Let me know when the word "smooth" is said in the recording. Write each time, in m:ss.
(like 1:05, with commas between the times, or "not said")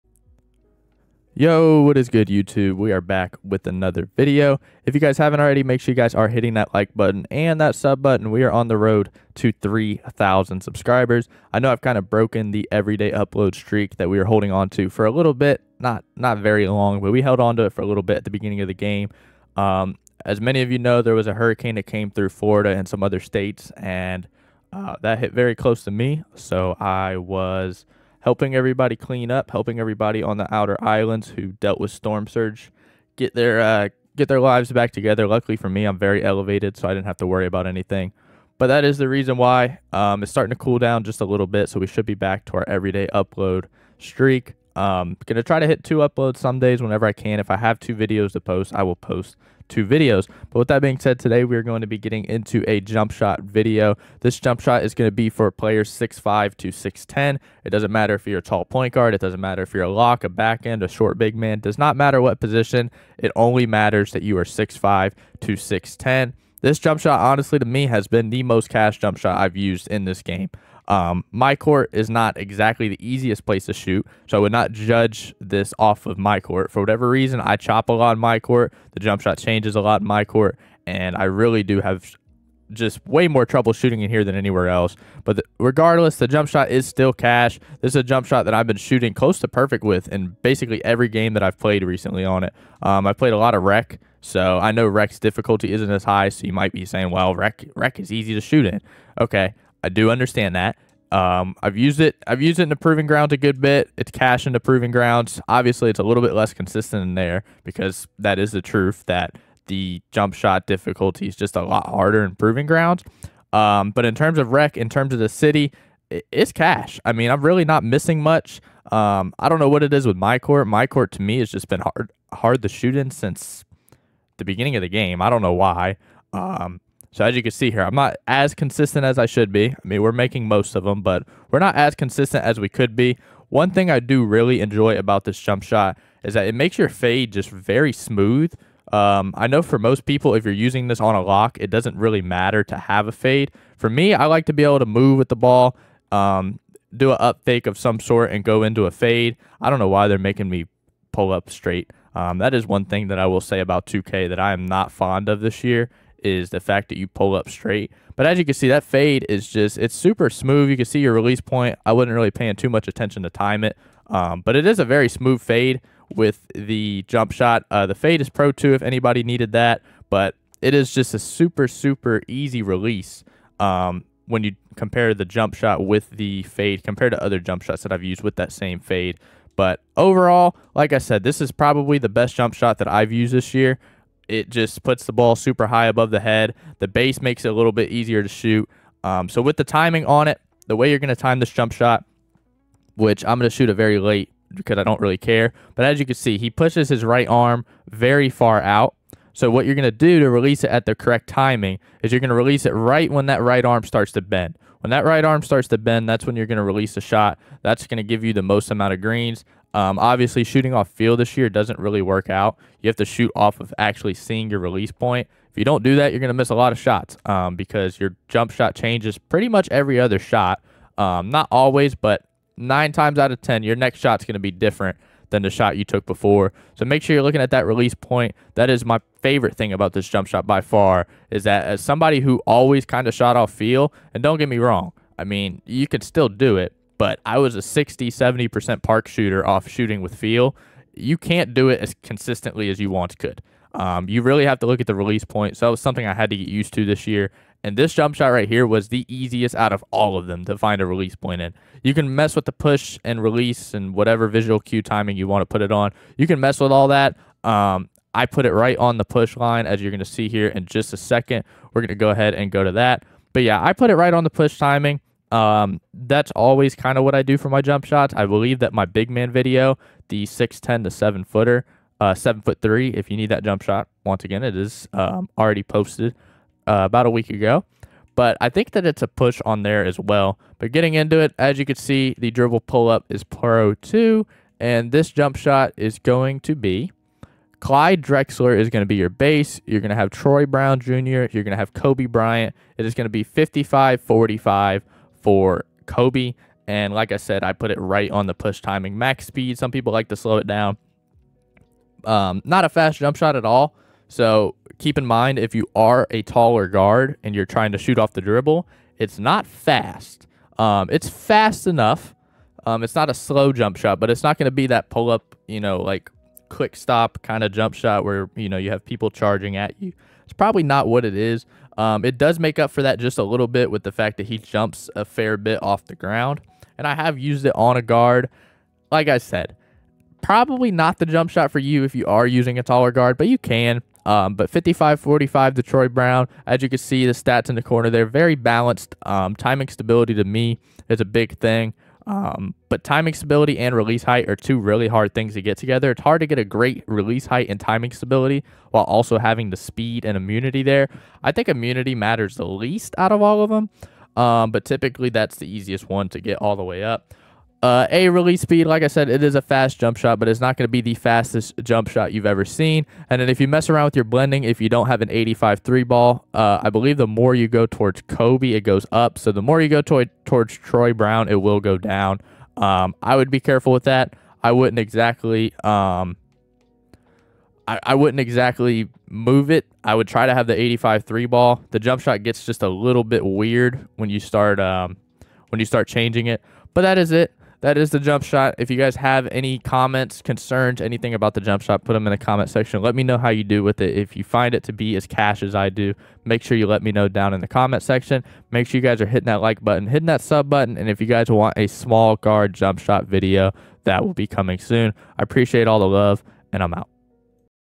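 2:17, 2:40, 2:45.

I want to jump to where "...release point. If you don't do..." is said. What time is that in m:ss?
3:34.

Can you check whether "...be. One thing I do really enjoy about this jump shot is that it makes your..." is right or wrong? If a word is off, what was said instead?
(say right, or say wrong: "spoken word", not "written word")
right.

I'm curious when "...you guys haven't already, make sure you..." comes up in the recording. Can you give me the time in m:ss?
0:04.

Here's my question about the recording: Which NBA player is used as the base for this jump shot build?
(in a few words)
Clyde Drexler.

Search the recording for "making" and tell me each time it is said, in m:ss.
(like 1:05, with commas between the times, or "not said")
2:10, 2:30.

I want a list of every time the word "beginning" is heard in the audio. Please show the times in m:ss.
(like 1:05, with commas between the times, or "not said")
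0:18, 2:04.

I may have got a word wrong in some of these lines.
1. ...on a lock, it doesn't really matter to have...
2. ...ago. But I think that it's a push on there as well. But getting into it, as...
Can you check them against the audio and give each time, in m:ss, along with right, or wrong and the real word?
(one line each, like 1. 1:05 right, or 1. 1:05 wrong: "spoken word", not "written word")
1. 2:21 right
2. 4:37 right.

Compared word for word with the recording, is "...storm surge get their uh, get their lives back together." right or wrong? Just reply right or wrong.
right.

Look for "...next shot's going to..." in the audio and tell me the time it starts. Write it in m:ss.
3:43.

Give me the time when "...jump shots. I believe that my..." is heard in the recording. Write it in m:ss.
4:27.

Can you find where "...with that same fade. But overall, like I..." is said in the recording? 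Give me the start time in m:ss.
2:58.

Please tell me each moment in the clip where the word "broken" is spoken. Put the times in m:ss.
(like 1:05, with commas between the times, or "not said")
0:12.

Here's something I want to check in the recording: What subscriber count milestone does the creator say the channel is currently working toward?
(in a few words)
3,000.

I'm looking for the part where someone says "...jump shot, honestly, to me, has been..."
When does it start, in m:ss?
1:06.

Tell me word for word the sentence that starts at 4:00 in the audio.
You can't do it as consistently as you once could.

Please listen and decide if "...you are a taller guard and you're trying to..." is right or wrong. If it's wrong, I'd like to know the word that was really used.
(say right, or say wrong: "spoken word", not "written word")
right.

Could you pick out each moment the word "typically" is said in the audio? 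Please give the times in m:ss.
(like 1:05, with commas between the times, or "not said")
5:54.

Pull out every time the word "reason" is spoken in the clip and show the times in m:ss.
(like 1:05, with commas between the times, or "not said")
0:39, 1:17.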